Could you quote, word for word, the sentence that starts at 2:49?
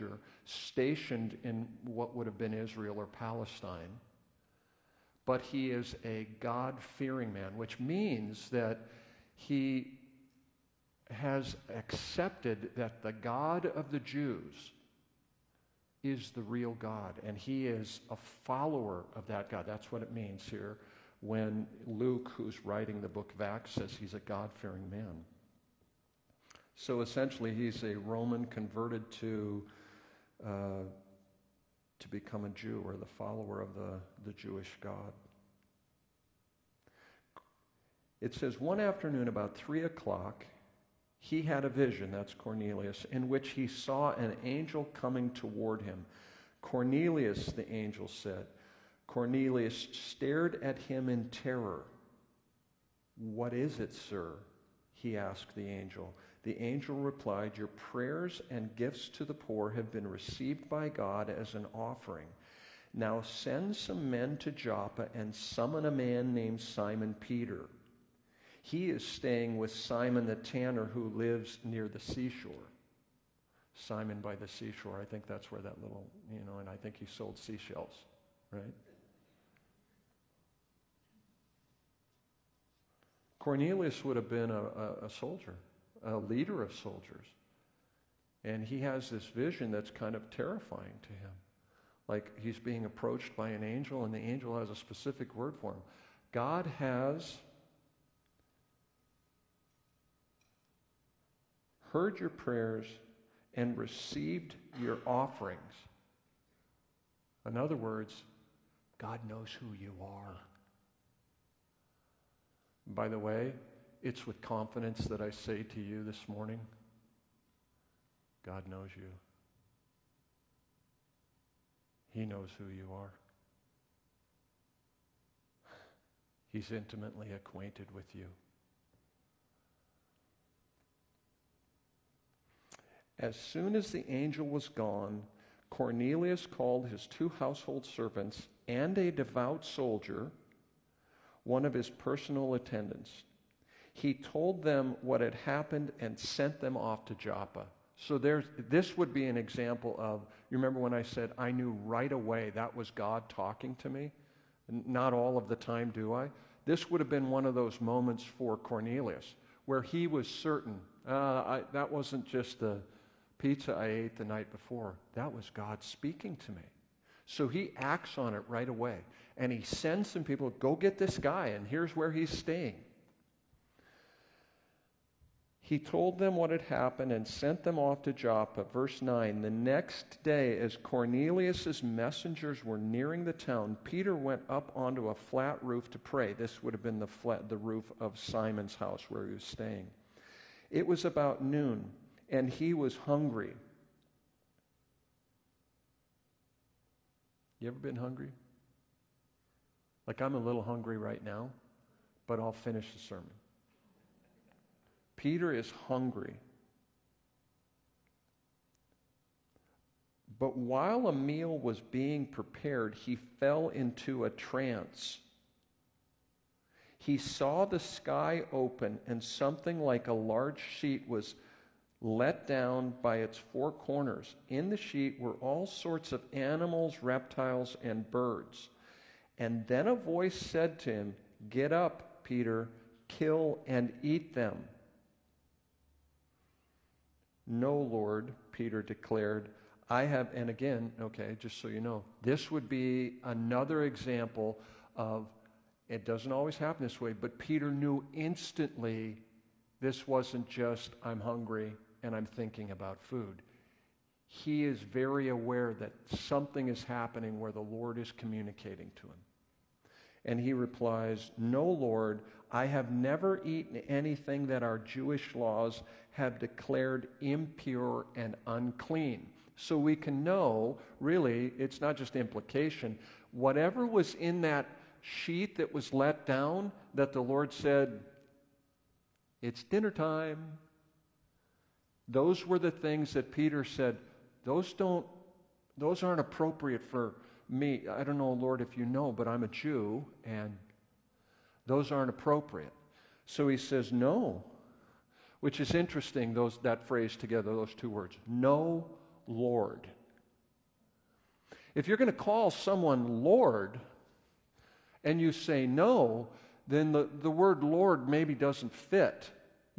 And he sends some people, go get this guy, and here's where he's staying.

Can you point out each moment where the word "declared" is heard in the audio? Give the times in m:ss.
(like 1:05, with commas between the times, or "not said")
3:58, 4:26.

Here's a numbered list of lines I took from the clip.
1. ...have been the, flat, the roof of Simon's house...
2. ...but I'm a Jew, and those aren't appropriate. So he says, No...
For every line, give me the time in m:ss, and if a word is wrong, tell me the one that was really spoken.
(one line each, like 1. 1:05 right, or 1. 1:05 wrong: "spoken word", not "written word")
1. 3:06 right
2. 4:49 right.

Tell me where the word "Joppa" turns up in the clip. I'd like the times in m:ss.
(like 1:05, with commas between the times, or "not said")
1:04, 2:27, 2:58.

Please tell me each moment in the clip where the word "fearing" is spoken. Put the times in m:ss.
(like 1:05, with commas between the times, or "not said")
0:06, 0:24.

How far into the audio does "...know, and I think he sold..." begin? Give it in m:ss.
1:16.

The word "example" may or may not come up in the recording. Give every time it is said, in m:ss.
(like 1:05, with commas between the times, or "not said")
2:29, 4:03.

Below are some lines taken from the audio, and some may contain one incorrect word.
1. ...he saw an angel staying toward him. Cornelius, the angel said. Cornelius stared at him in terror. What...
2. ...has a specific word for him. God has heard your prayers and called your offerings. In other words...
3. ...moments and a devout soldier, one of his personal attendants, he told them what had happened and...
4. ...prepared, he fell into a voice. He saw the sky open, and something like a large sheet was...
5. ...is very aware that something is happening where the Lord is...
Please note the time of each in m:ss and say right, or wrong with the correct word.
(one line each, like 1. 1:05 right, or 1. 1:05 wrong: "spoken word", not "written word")
1. 0:43 wrong: "coming", not "staying"
2. 1:34 wrong: "received", not "called"
3. 2:17 wrong: "servants", not "moments"
4. 3:32 wrong: "trance", not "voice"
5. 4:14 right.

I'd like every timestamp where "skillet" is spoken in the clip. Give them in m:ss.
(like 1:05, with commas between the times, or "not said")
not said.